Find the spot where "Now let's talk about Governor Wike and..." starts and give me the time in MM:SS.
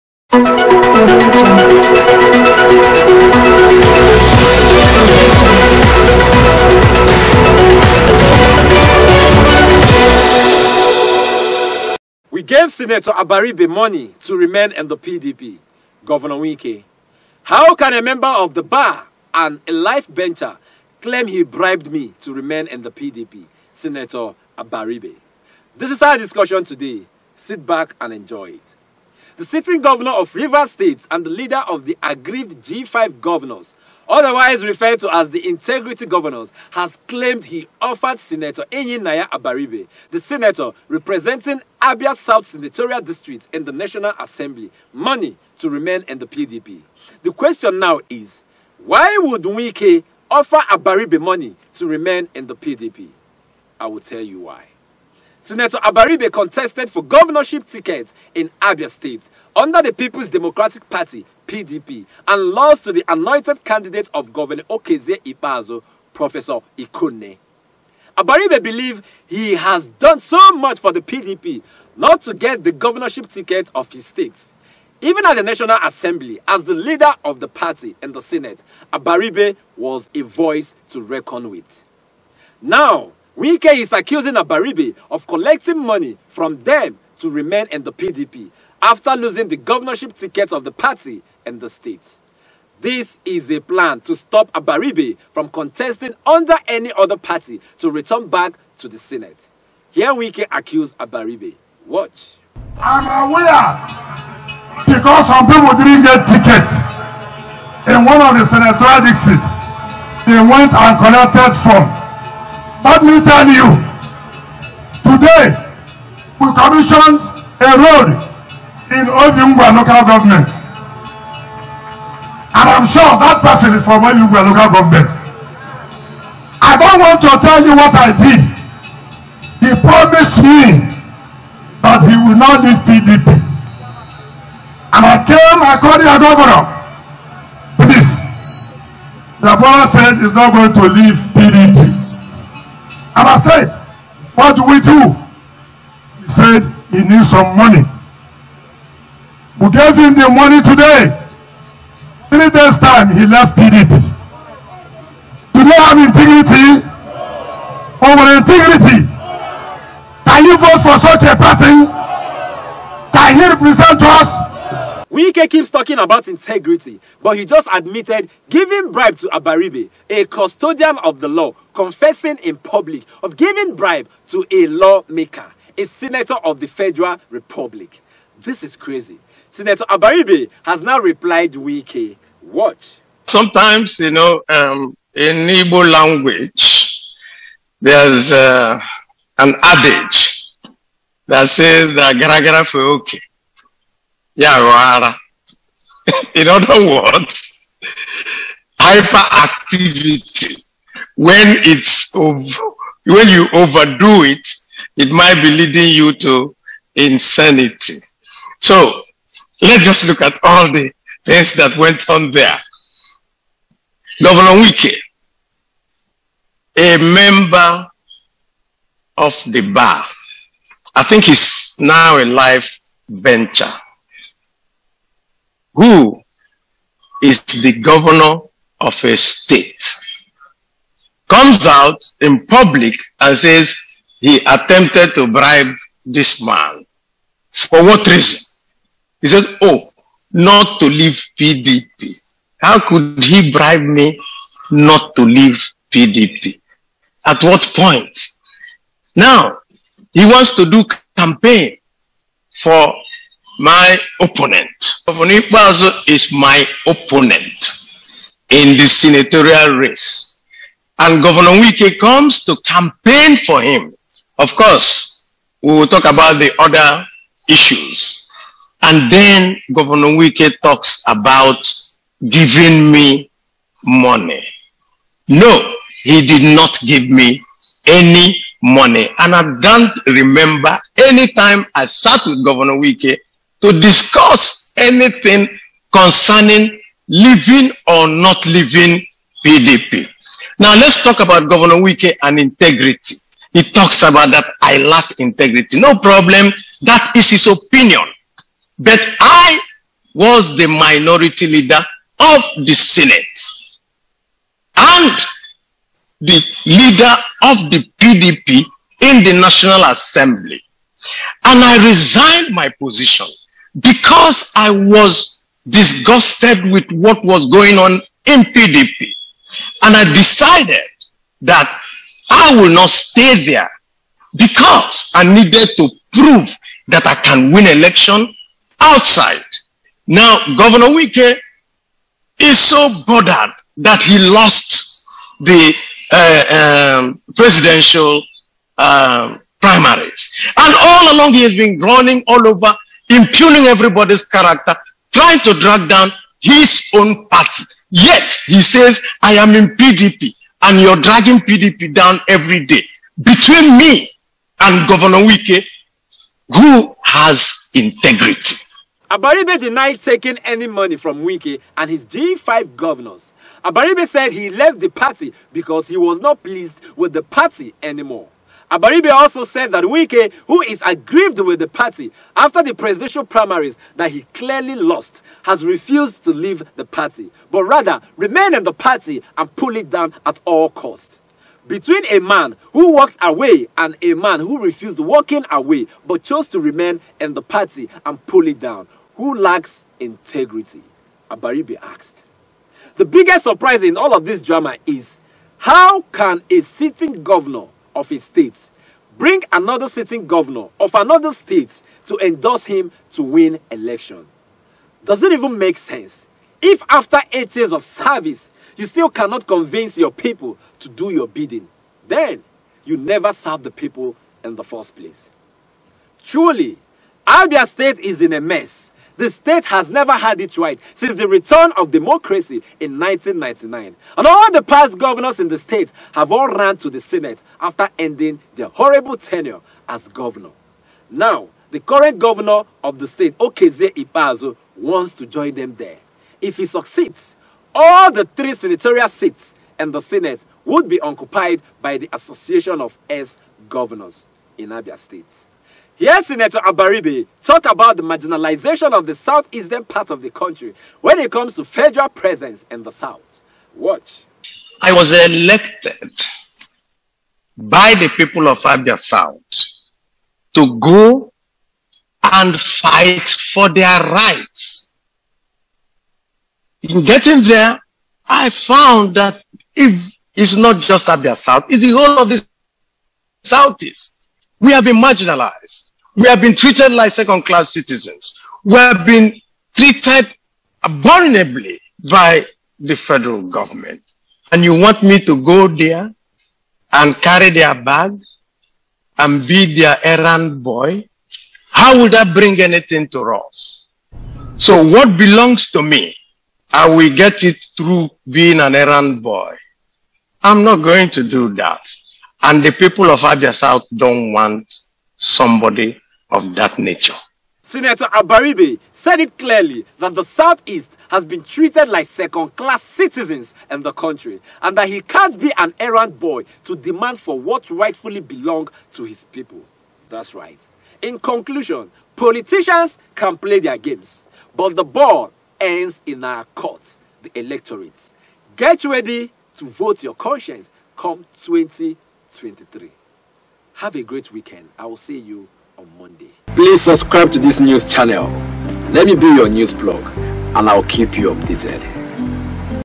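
04:50.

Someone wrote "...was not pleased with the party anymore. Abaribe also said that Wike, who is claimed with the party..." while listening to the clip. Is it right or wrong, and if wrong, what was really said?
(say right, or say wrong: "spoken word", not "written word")
wrong: "aggrieved", not "claimed".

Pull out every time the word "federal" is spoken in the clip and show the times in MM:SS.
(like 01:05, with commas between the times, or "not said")
02:56, 07:31, 08:02.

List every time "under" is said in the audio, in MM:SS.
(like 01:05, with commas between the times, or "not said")
00:59, 01:36.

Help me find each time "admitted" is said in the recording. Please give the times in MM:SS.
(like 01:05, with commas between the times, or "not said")
02:47.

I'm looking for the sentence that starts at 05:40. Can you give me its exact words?
And all along he has been running all over impugning everybody's character, trying to drag down his own party.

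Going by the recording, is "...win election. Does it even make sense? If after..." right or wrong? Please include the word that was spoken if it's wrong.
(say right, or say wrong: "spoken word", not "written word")
right.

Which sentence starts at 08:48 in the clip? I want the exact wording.
Get ready to vote your conscience come 2023.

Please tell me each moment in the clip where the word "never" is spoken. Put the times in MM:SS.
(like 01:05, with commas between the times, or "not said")
06:52, 06:59.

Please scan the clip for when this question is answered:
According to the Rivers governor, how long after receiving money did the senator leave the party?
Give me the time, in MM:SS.
02:32.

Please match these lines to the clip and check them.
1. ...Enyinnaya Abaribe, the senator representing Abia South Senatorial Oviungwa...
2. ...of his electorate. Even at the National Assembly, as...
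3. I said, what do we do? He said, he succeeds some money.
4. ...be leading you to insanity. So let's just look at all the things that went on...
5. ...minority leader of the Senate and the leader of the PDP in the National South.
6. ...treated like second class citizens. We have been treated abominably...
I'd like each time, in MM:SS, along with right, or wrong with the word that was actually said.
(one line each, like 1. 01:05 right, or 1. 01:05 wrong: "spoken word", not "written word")
1. 00:38 wrong: "District", not "Oviungwa"
2. 01:13 wrong: "state", not "electorate"
3. 02:23 wrong: "needs", not "succeeds"
4. 03:25 right
5. 05:00 wrong: "Assembly", not "South"
6. 07:56 right.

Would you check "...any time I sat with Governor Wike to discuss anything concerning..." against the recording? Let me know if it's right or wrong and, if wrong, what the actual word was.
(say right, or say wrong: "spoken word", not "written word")
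right.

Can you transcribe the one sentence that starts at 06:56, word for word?
Truly, Abia State is in a mess.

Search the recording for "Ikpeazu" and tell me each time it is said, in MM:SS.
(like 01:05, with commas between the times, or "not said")
04:15, 07:13.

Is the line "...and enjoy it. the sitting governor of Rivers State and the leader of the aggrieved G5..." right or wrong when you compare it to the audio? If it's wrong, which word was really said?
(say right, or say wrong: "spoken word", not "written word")
right.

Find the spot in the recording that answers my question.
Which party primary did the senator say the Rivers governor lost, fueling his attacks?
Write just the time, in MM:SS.
05:37.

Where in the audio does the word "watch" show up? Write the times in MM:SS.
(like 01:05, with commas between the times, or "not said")
01:41, 03:02, 07:33.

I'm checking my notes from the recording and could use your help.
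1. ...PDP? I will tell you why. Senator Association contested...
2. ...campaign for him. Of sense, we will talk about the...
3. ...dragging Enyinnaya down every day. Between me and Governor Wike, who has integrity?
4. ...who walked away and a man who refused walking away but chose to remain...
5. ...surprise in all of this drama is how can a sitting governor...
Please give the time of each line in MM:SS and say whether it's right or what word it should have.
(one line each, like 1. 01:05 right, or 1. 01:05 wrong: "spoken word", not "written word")
1. 00:52 wrong: "Abaribe", not "Association"
2. 04:22 wrong: "course", not "sense"
3. 05:50 wrong: "PDP", not "Enyinnaya"
4. 06:22 right
5. 06:33 right.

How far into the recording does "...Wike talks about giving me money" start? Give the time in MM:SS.
04:30.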